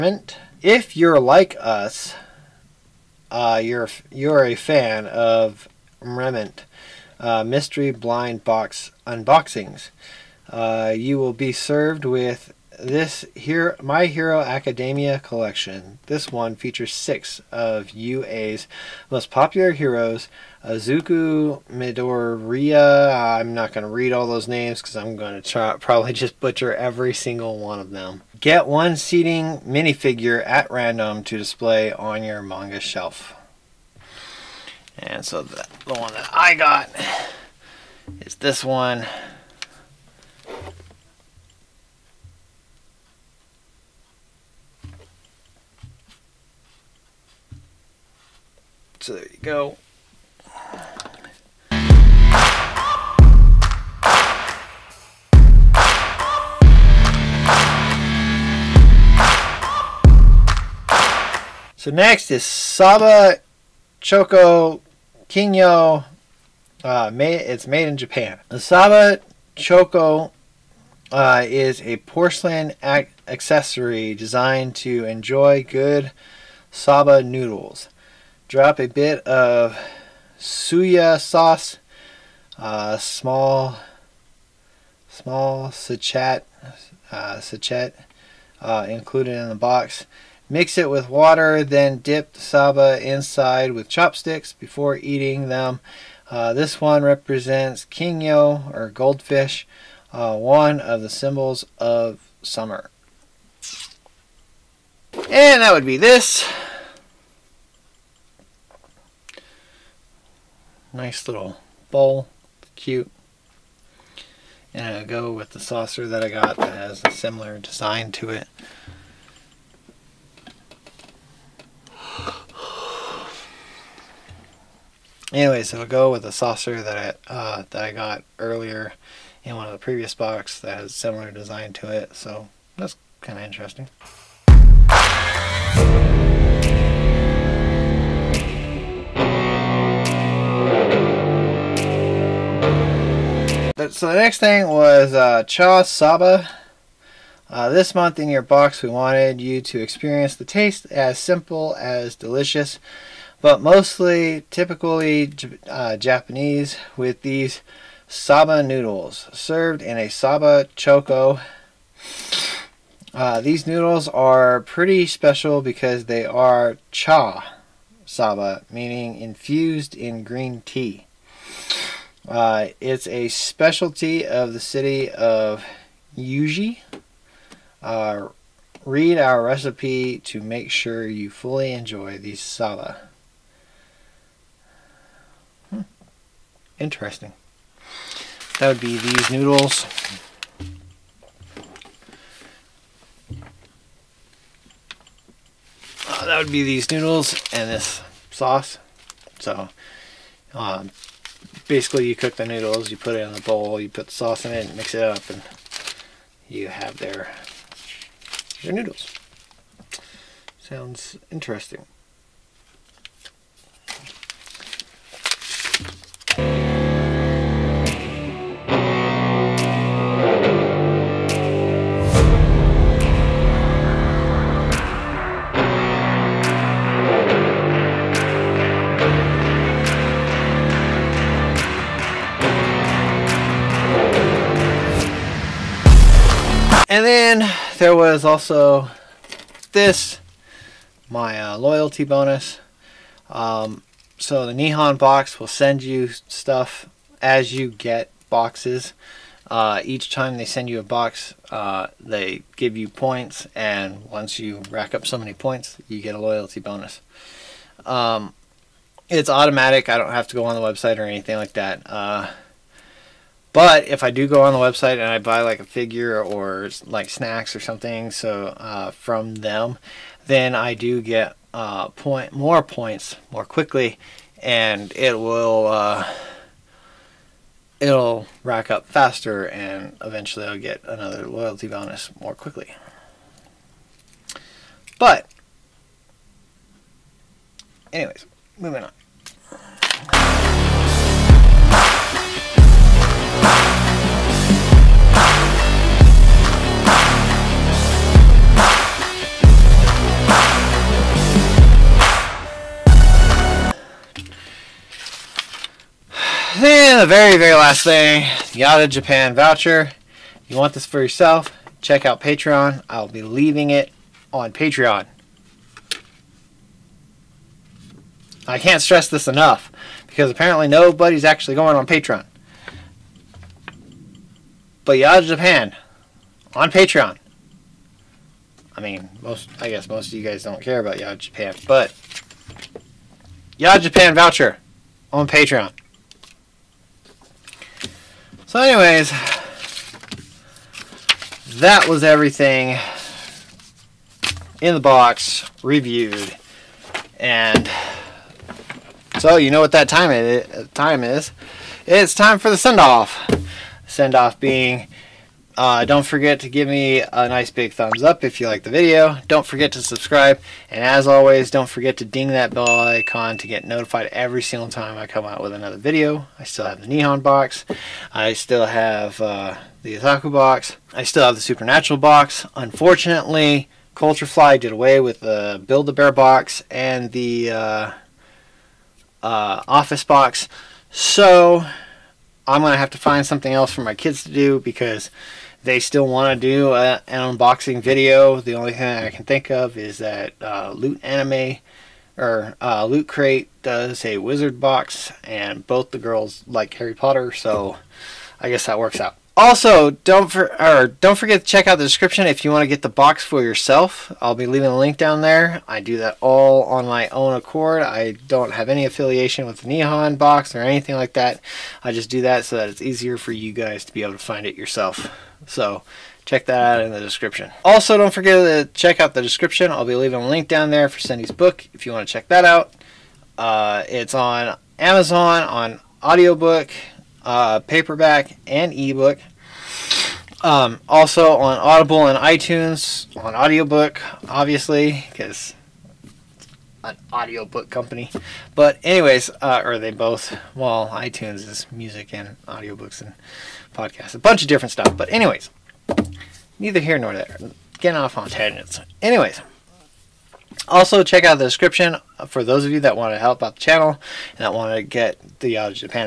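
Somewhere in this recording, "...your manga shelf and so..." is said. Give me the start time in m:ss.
0:32.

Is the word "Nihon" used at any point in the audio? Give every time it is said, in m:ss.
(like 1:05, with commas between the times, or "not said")
4:04, 6:06, 6:49.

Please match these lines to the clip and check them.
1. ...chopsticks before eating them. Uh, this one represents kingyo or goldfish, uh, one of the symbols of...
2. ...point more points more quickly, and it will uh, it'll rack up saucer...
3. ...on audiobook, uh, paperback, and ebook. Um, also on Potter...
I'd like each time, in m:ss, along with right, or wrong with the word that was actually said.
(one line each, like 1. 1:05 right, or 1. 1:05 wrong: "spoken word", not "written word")
1. 1:33 right
2. 4:31 wrong: "faster", not "saucer"
3. 7:05 wrong: "Audible", not "Potter".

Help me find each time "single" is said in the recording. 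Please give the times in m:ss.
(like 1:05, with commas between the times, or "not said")
0:27, 6:04.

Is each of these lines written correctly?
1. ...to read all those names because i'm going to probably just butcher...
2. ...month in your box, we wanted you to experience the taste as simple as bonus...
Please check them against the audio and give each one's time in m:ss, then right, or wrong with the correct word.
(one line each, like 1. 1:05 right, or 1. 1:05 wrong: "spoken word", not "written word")
1. 0:23 right
2. 2:27 wrong: "delicious", not "bonus".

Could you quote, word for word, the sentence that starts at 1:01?
So next is Saba Choco Kingyo.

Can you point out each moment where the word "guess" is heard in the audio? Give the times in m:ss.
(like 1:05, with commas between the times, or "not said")
5:29, 6:38.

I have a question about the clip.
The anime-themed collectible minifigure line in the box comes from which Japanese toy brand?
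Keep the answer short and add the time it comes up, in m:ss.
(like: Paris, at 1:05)
Re-Ment, at 0:06.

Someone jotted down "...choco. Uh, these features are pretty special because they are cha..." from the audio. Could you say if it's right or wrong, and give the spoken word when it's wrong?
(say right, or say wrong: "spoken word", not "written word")
wrong: "noodles", not "features".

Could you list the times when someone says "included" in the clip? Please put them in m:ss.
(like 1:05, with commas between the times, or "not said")
1:28.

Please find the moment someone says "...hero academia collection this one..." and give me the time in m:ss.
0:14.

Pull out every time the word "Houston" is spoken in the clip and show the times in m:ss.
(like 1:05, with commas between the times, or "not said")
not said.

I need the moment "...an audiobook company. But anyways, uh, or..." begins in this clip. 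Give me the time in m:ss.
7:16.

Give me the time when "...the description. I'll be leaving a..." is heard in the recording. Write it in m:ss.
6:59.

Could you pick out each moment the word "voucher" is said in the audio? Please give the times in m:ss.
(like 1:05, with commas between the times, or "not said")
5:09, 5:34.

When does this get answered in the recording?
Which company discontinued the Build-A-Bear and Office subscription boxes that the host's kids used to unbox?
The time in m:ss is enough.
6:13.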